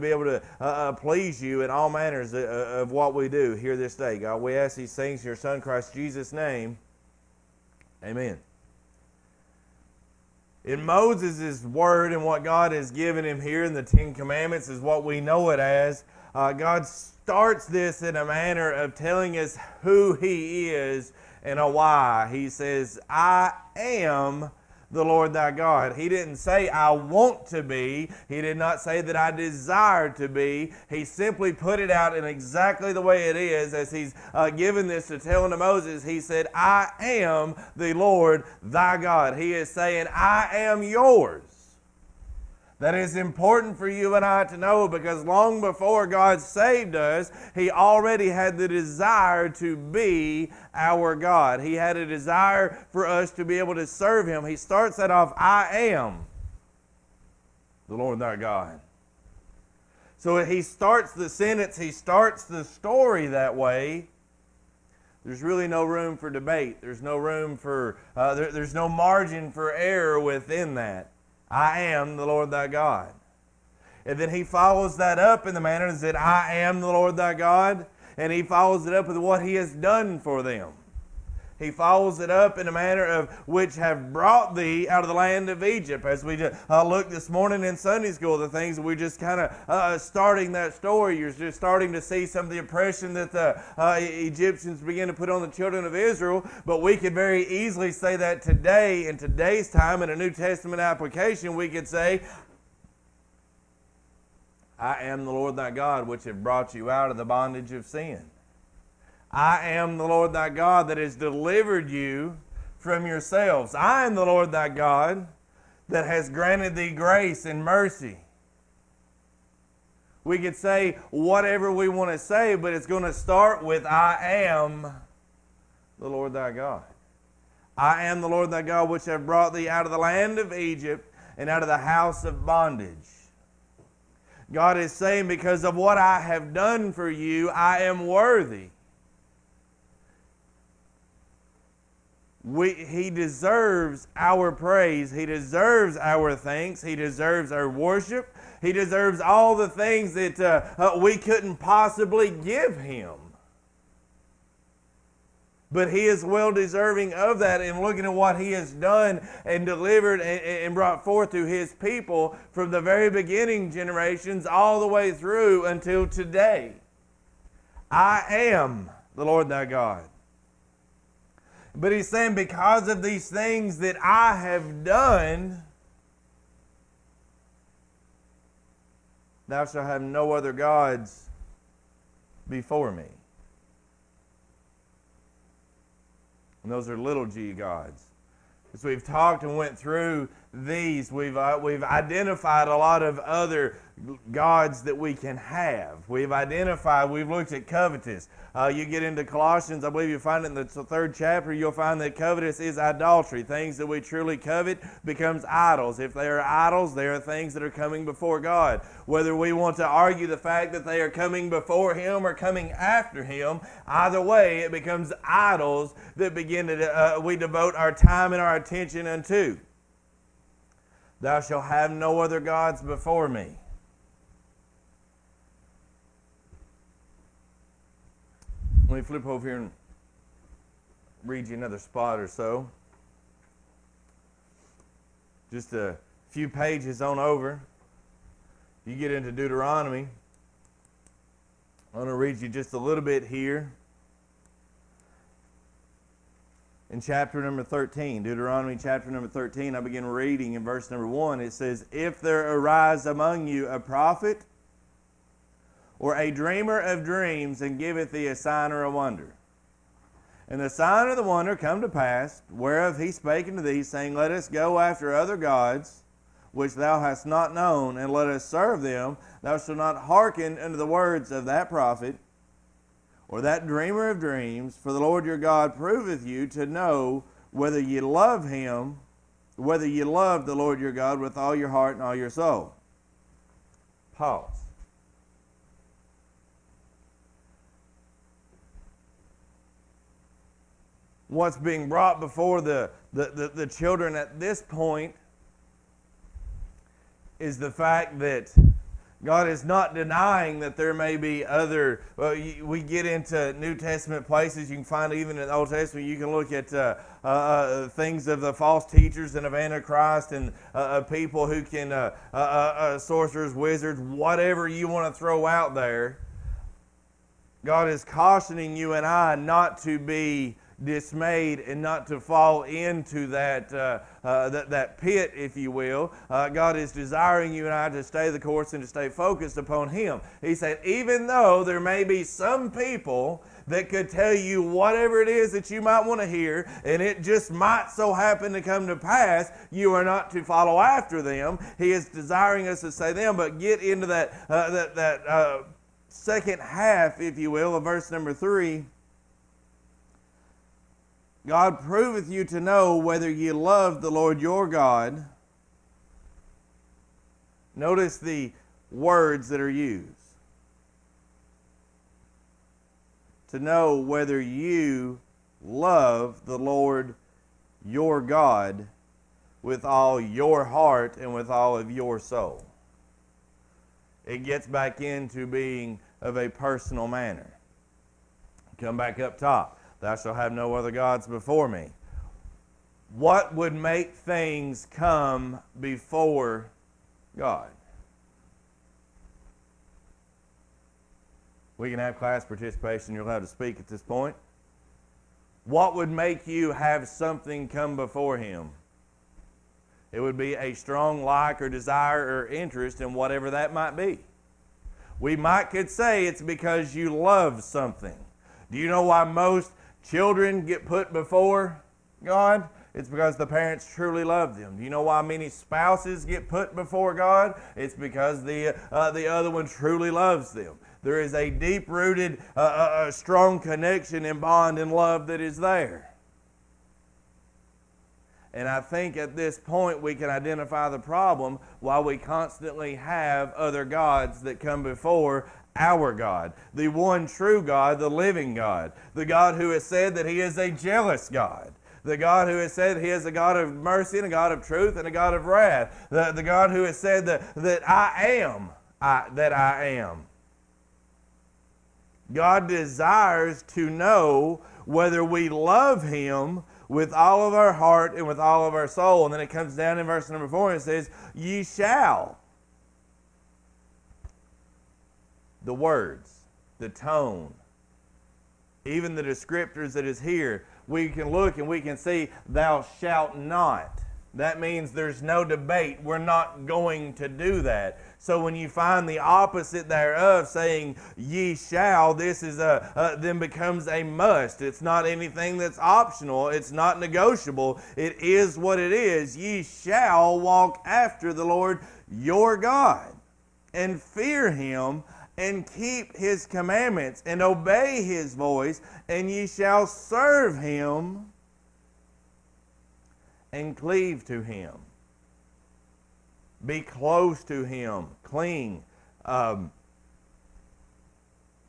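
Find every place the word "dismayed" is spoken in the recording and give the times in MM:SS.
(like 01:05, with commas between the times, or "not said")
05:20.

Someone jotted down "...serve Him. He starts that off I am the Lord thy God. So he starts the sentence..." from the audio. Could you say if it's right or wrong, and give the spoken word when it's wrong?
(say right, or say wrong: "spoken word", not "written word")
right.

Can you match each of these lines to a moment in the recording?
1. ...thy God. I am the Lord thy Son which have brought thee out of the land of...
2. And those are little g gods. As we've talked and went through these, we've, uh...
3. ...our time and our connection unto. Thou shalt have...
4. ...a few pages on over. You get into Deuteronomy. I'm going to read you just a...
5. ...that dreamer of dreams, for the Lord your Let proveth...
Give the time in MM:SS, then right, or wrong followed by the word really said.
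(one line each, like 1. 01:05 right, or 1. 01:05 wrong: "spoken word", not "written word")
1. 02:06 wrong: "God", not "Son"
2. 03:06 right
3. 03:37 wrong: "attention", not "connection"
4. 03:55 right
5. 04:33 wrong: "God", not "Let".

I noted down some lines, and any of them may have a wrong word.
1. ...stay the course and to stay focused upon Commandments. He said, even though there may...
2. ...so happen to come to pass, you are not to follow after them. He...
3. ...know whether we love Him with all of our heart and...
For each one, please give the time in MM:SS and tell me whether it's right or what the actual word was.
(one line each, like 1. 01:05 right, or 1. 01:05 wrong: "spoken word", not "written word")
1. 05:28 wrong: "Him", not "Commandments"
2. 05:37 right
3. 07:33 right.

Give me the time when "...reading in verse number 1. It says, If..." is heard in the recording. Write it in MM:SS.
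04:10.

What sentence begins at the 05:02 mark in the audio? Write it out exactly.
Well, we get into New Testament places.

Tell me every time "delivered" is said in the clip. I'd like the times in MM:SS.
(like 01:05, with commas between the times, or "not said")
01:51, 02:39.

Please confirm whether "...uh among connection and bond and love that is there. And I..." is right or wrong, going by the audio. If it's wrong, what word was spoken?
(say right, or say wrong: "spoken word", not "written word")
wrong: "strong", not "among".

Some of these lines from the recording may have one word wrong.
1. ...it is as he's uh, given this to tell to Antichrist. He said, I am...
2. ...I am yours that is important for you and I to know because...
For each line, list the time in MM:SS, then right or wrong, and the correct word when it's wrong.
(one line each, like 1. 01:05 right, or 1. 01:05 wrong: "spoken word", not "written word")
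1. 00:33 wrong: "Moses", not "Antichrist"
2. 00:40 right.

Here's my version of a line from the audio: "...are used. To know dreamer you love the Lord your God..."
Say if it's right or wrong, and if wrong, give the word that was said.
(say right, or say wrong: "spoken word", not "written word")
wrong: "whether", not "dreamer".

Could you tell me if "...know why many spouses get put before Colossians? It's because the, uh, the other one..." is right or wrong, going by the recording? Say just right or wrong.
wrong.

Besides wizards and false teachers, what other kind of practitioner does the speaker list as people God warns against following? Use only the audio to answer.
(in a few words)
Sorcerers.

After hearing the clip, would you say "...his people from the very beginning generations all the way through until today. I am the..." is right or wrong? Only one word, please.
right.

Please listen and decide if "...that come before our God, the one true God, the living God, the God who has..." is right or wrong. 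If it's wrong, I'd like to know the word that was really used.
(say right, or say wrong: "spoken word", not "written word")
right.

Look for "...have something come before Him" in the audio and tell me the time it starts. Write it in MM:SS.
06:36.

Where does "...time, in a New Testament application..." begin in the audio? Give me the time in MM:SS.
01:39.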